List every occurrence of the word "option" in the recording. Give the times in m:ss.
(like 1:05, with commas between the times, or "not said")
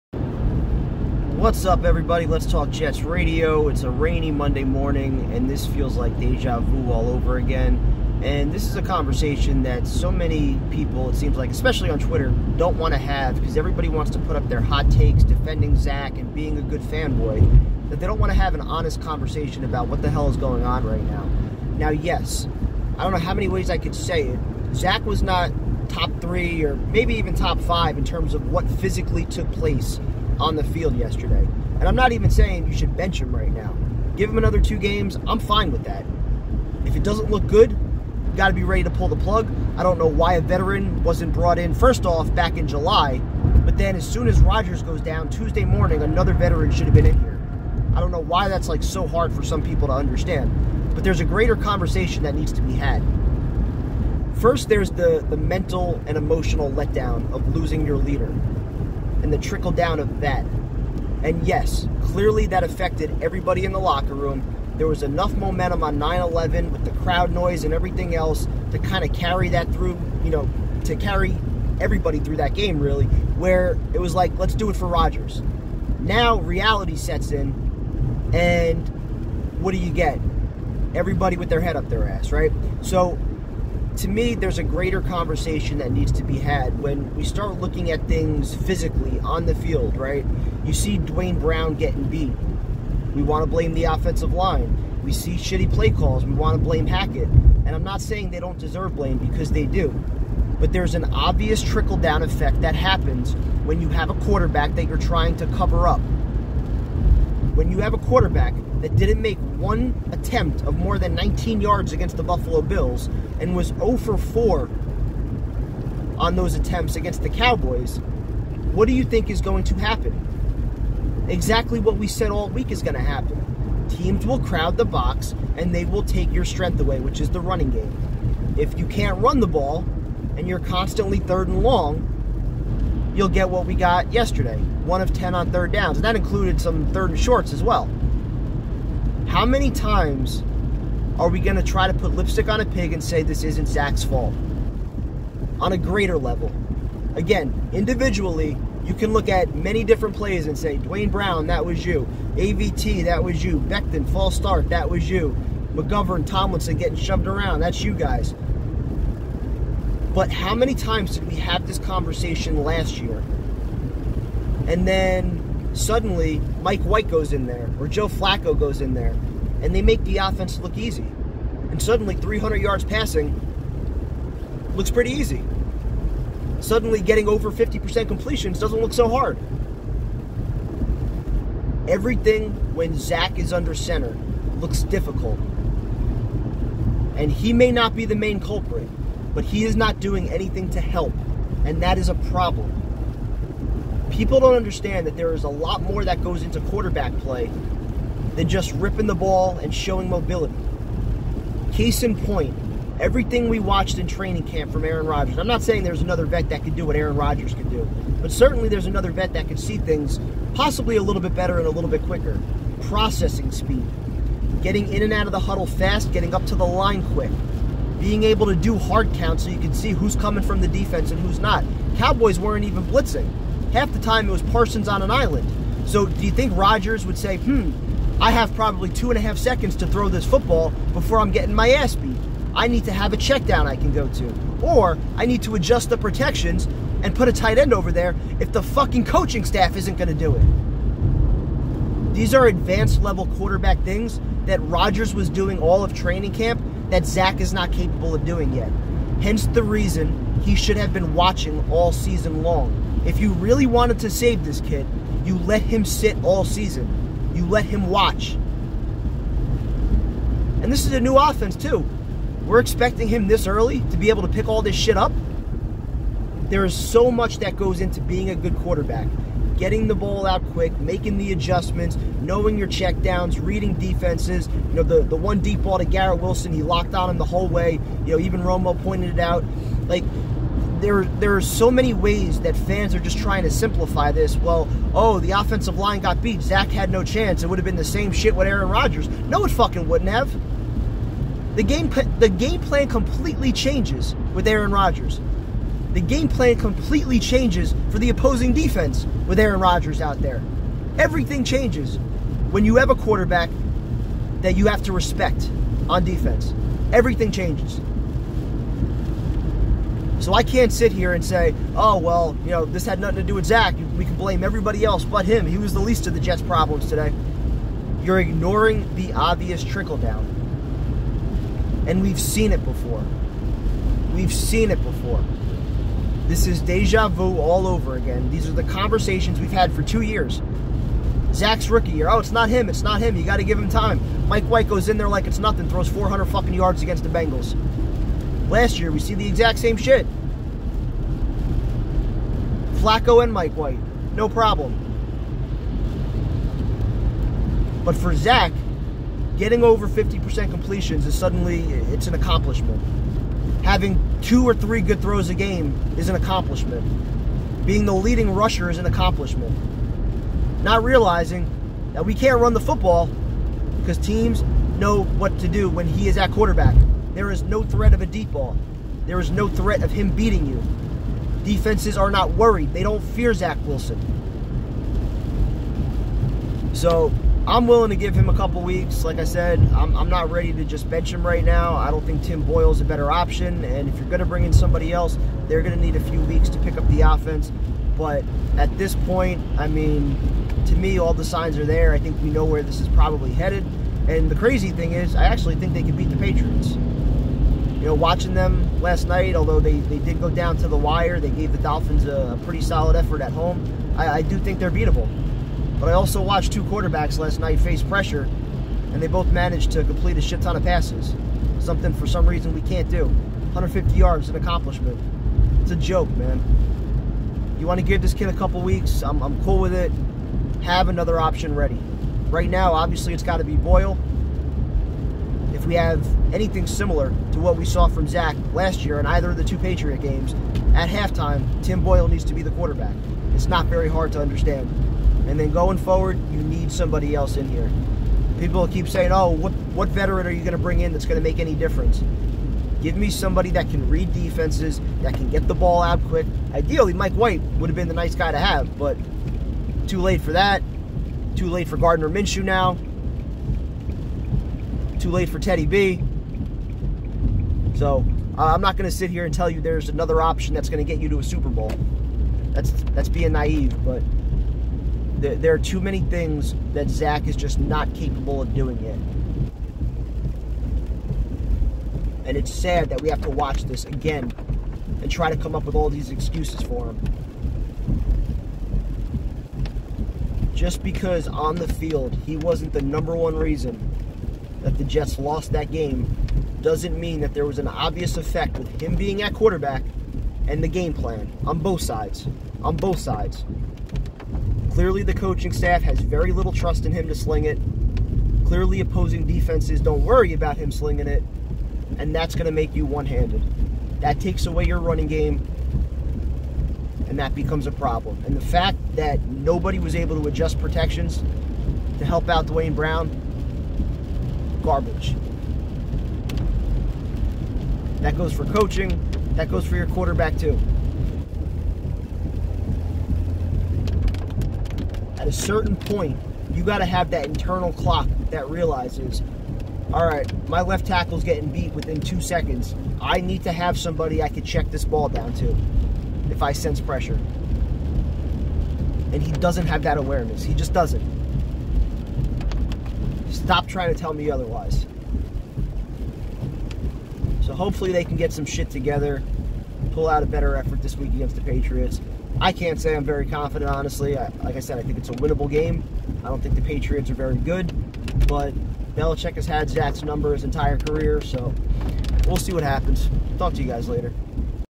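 6:23, 7:01, 7:40.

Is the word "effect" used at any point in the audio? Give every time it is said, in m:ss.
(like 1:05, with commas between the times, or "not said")
1:42, 8:08.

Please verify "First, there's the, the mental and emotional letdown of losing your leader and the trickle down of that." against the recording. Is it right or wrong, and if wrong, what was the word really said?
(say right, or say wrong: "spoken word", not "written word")
right.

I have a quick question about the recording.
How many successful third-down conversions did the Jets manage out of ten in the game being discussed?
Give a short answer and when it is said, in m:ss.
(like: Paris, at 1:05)
1, at 2:14.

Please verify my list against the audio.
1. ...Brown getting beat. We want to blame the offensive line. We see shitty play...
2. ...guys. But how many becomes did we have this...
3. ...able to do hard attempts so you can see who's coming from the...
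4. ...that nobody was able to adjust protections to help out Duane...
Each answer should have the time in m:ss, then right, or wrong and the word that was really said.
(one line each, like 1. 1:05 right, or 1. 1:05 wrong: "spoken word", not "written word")
1. 1:31 right
2. 2:37 wrong: "times", not "becomes"
3. 3:38 wrong: "counts", not "attempts"
4. 8:28 right.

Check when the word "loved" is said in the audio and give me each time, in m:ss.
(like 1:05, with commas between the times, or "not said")
not said.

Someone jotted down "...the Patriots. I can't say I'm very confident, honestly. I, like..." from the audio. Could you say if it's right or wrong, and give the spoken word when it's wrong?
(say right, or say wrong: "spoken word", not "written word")
right.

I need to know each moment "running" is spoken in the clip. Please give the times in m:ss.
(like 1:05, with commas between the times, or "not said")
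2:07, 8:24.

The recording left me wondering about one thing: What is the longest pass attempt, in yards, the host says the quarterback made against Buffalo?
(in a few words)
19.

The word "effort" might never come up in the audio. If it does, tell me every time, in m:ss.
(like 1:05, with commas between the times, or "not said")
6:42, 9:10.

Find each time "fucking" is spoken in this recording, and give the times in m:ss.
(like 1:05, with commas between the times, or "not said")
3:58, 4:49, 5:36.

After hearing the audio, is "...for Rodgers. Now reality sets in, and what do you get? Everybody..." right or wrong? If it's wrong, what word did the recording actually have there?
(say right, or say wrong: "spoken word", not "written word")
right.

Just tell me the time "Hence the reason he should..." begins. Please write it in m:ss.
4:09.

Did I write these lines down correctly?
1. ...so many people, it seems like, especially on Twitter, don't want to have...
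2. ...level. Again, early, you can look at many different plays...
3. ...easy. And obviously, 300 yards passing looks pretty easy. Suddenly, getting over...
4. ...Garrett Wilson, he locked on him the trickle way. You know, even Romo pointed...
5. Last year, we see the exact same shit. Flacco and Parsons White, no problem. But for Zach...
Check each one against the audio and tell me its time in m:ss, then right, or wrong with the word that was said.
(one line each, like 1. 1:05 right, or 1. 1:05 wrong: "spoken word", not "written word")
1. 0:09 right
2. 2:26 wrong: "individually", not "early"
3. 2:50 wrong: "suddenly", not "obviously"
4. 4:35 wrong: "whole", not "trickle"
5. 5:38 wrong: "Mike", not "Parsons".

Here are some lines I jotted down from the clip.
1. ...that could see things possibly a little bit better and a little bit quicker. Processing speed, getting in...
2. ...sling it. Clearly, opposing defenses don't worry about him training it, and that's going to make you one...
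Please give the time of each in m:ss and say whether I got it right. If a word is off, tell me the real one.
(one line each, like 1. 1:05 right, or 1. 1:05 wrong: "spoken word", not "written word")
1. 3:29 right
2. 8:17 wrong: "slinging", not "training".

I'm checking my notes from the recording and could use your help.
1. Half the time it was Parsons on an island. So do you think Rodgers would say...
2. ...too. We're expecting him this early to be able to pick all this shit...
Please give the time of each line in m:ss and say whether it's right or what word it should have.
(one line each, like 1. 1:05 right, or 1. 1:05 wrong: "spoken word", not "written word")
1. 3:43 right
2. 4:21 right.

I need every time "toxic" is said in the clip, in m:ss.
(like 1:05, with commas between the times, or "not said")
not said.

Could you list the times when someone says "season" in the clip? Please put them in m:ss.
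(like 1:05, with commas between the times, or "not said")
4:11, 4:16.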